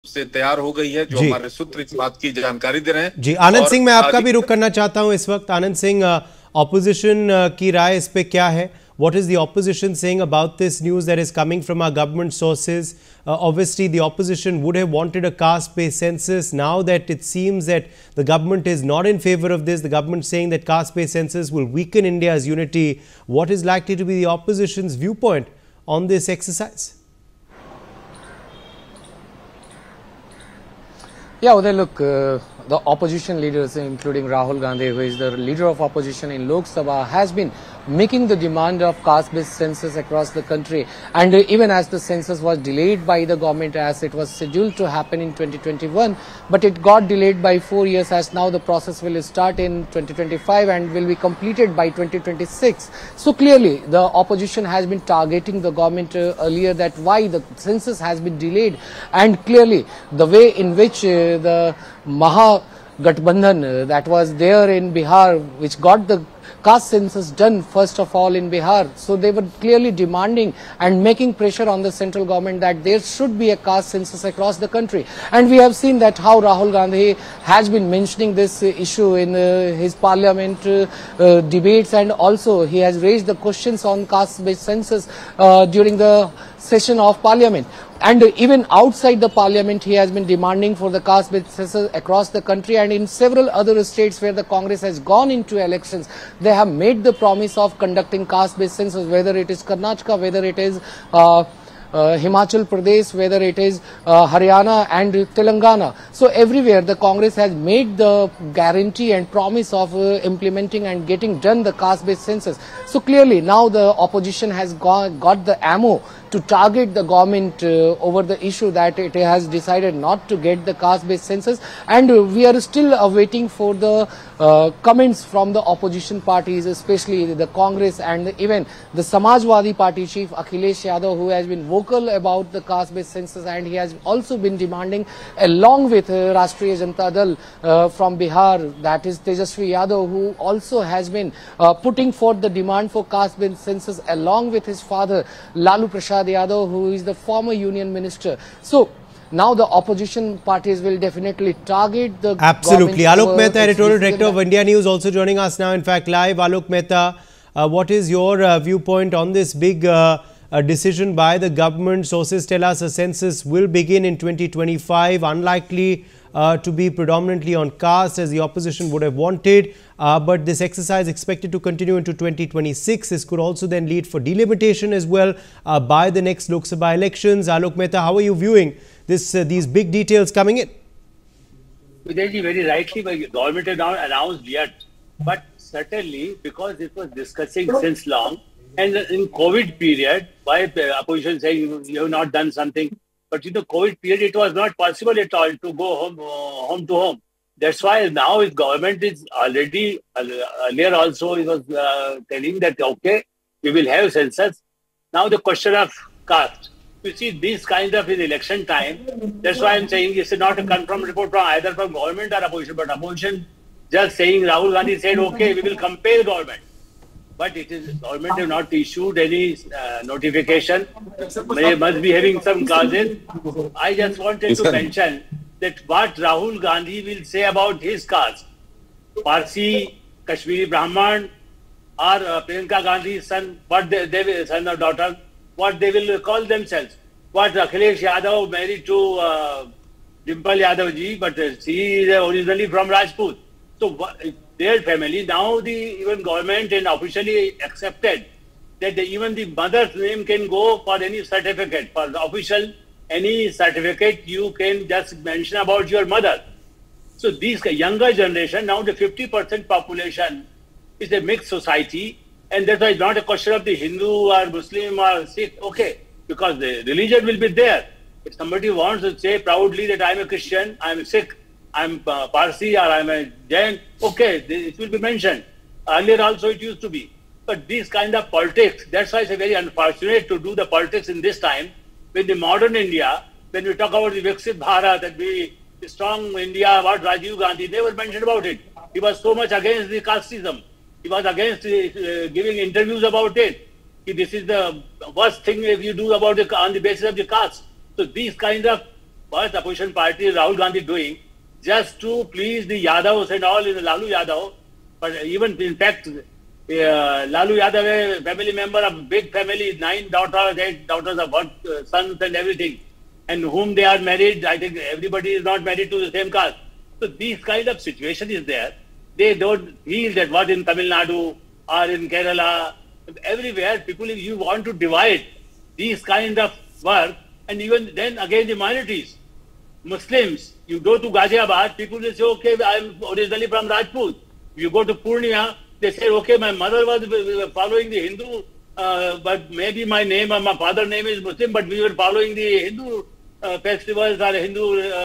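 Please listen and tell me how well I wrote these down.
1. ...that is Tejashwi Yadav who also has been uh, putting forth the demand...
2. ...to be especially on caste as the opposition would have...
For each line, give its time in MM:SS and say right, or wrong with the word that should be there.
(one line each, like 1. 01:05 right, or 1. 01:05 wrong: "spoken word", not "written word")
1. 02:18 right
2. 02:46 wrong: "predominantly", not "especially".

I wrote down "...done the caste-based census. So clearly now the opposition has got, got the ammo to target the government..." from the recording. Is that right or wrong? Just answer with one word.
right.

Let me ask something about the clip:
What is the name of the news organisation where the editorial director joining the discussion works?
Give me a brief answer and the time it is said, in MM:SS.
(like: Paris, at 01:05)
India News, at 02:34.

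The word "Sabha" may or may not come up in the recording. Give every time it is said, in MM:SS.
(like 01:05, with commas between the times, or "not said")
00:36, 02:56.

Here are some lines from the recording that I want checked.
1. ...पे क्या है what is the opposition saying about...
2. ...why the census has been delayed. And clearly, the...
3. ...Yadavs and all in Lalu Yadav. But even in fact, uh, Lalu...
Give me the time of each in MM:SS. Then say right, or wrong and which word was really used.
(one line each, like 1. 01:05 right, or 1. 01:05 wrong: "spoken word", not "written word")
1. 00:08 right
2. 00:56 right
3. 05:02 right.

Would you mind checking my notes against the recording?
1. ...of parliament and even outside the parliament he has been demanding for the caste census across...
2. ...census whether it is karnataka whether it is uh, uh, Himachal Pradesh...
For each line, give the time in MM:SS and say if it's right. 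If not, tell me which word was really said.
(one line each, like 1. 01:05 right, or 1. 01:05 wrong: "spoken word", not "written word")
1. 01:26 right
2. 01:38 right.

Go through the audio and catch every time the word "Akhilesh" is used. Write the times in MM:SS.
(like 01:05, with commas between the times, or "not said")
02:10, 03:57.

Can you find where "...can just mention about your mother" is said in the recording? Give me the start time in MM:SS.
04:14.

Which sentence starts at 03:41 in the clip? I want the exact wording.
They must be having some causes.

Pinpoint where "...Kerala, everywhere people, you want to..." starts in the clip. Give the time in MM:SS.
05:22.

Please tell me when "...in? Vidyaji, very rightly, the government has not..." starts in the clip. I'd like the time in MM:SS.
03:00.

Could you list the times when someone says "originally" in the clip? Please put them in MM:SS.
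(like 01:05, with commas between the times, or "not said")
04:02, 05:33.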